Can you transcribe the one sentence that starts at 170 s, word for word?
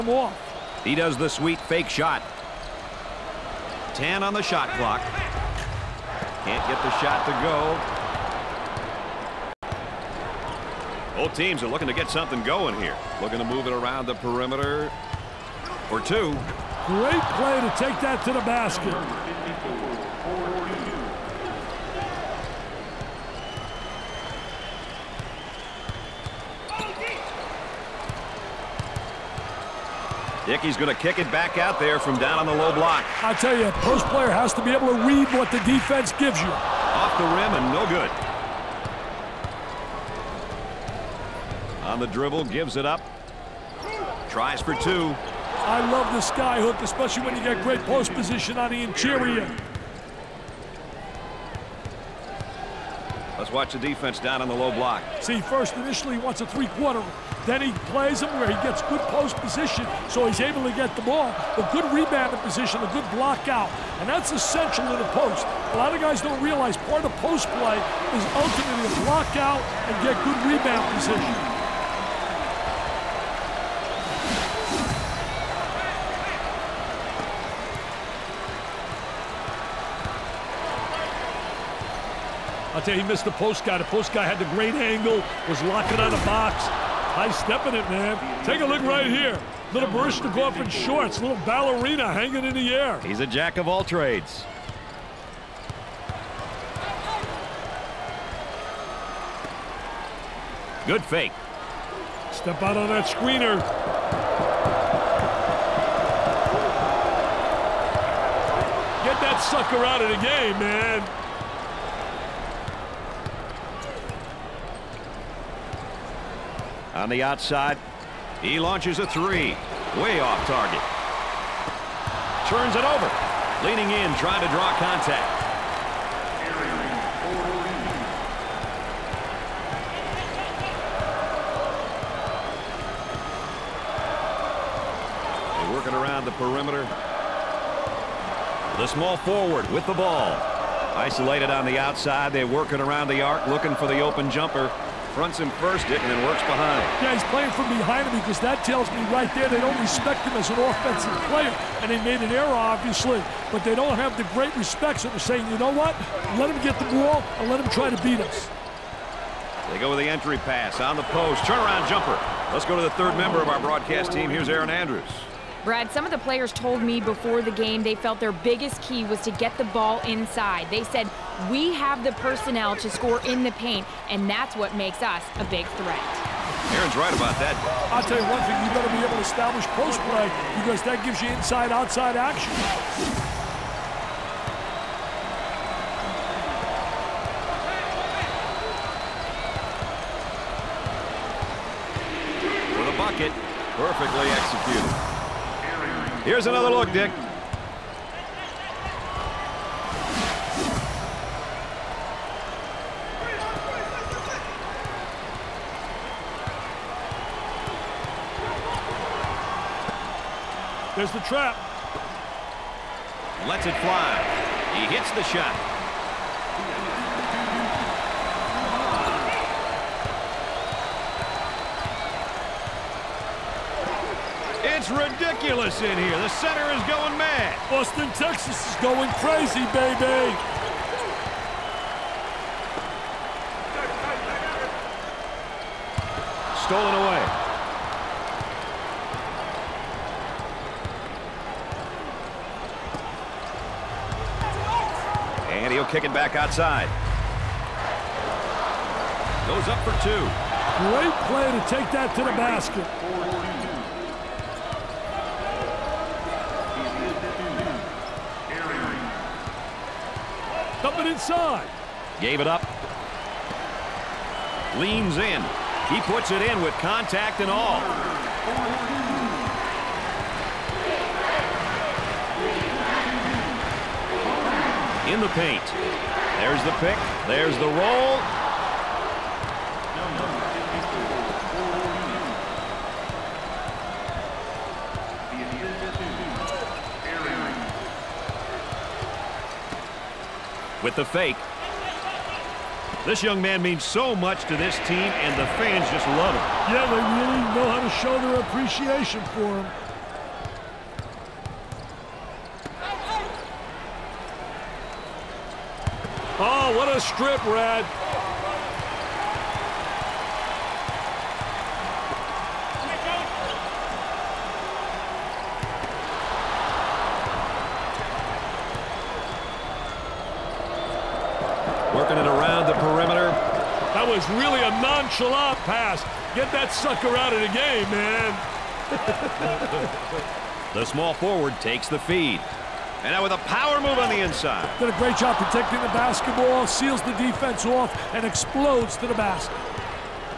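They said, we have the personnel to score in the paint, and that's what makes us a big threat.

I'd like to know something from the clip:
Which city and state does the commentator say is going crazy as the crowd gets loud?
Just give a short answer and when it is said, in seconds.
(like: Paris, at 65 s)
Austin, Texas, at 227 s.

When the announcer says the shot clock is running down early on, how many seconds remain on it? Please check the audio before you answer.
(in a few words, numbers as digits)
10.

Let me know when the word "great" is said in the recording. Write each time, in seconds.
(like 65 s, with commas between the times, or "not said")
16 s, 47 s, 84 s, 154 s, 250 s, 334 s.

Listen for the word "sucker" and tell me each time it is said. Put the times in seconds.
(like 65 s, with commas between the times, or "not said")
109 s, 326 s.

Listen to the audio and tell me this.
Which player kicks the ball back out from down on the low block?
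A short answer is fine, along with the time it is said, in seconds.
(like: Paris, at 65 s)
Dickey, at 30 s.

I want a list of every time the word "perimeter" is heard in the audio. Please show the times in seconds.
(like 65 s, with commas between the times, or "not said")
14 s, 136 s.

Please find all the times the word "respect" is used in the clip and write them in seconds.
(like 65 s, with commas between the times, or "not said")
149 s, 154 s.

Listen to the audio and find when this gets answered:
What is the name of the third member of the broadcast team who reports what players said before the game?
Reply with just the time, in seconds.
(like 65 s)
164 s.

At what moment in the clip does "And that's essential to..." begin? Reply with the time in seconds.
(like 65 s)
63 s.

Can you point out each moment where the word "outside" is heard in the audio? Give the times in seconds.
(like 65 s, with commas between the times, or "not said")
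117 s, 141 s, 181 s, 246 s.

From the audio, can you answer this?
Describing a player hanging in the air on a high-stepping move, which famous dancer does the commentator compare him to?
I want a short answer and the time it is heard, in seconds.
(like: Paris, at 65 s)
Baryshnikov, at 89 s.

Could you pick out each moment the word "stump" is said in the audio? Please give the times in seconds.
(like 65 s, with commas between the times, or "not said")
not said.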